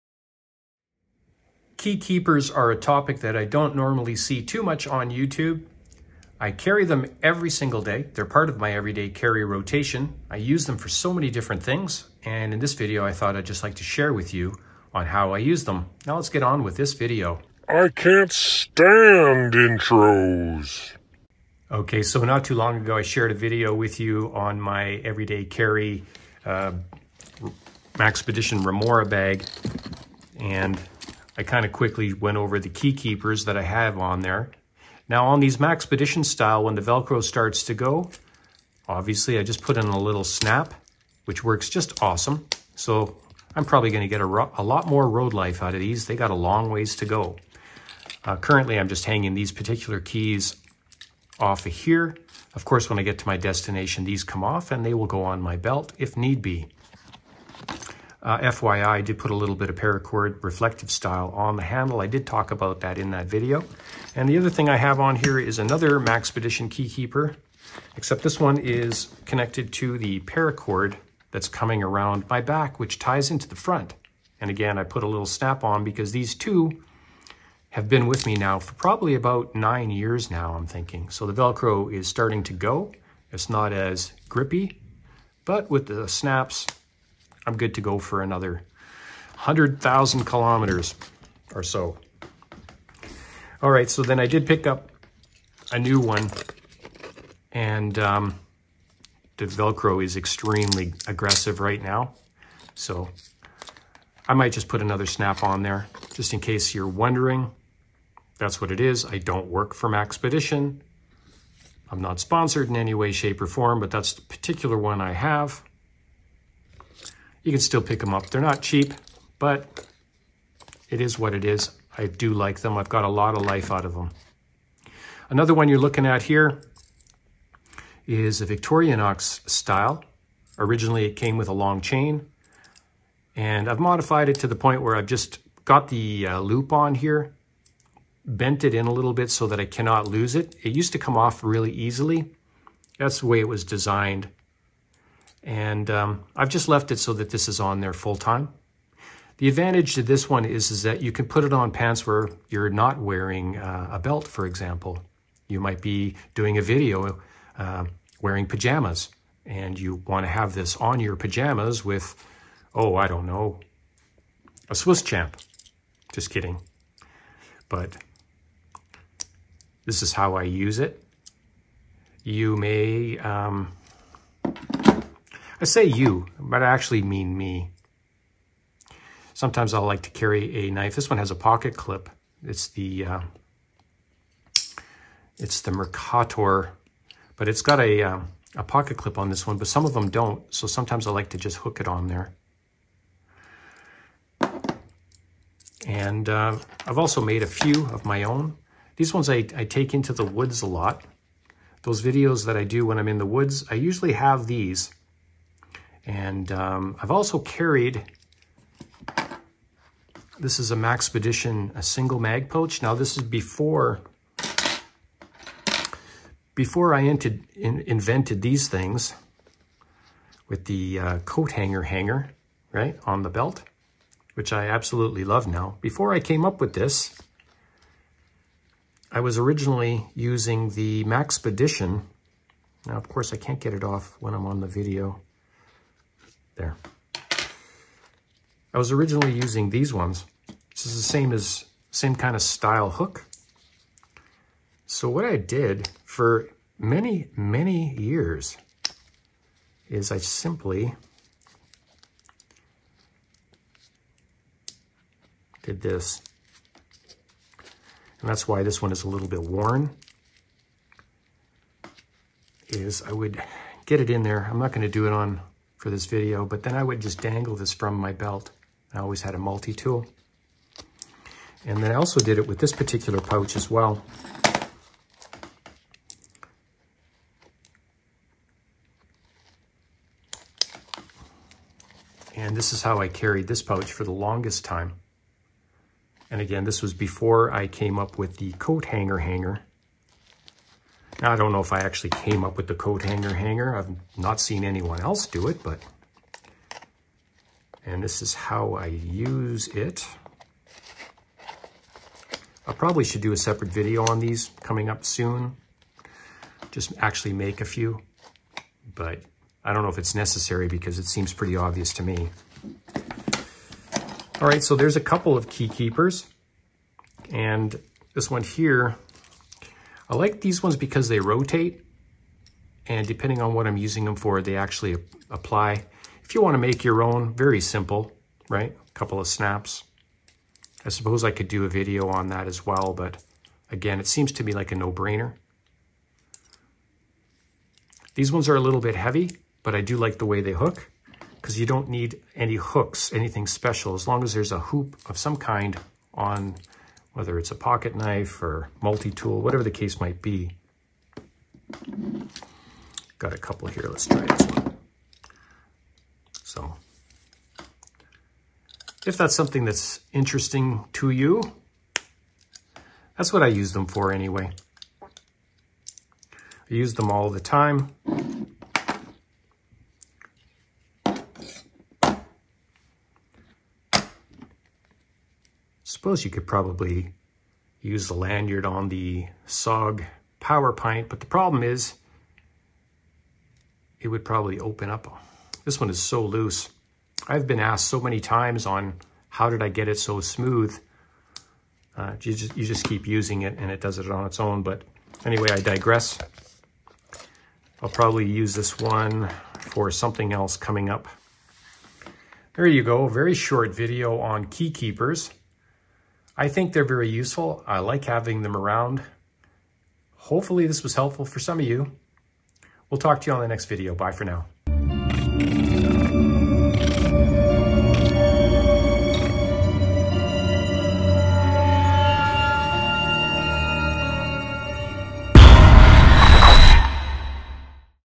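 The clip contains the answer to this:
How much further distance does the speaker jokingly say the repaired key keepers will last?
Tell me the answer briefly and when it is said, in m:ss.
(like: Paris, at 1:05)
100,000 kilometers, at 1:29.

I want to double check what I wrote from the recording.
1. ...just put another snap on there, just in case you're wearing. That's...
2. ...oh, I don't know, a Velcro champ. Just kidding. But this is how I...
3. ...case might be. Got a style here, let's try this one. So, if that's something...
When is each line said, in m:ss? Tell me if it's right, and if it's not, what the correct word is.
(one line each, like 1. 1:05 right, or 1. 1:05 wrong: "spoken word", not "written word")
1. 1:44 wrong: "wondering", not "wearing"
2. 2:42 wrong: "Swiss", not "Velcro"
3. 5:49 wrong: "couple", not "style".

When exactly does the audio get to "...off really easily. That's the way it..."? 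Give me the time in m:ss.
2:21.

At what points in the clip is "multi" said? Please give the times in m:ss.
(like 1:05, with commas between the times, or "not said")
4:29, 5:48.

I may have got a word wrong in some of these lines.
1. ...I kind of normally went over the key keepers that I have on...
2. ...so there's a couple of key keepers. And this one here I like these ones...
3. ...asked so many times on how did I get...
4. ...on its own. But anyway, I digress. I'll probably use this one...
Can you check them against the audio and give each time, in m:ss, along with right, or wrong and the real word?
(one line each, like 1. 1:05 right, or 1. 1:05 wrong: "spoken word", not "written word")
1. 0:31 wrong: "quickly", not "normally"
2. 5:14 right
3. 6:27 right
4. 6:34 right.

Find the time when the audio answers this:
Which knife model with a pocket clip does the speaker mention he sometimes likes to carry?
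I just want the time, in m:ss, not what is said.
3:05.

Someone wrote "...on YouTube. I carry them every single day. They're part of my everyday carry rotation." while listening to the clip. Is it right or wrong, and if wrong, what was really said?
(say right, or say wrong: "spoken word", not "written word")
right.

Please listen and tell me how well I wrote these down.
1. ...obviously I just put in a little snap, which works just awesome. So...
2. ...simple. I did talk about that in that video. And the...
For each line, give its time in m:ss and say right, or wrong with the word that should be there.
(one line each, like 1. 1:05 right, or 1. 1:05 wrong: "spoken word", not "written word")
1. 0:38 right
2. 1:01 wrong: "handle", not "simple".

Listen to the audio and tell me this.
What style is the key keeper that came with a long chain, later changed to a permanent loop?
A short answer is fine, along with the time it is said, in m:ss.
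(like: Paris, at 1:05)
ox, at 2:09.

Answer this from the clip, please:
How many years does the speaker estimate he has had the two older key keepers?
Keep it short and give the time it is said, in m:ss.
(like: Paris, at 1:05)
9, at 1:19.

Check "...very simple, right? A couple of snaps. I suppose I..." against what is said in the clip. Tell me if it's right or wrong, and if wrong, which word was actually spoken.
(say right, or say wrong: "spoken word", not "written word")
right.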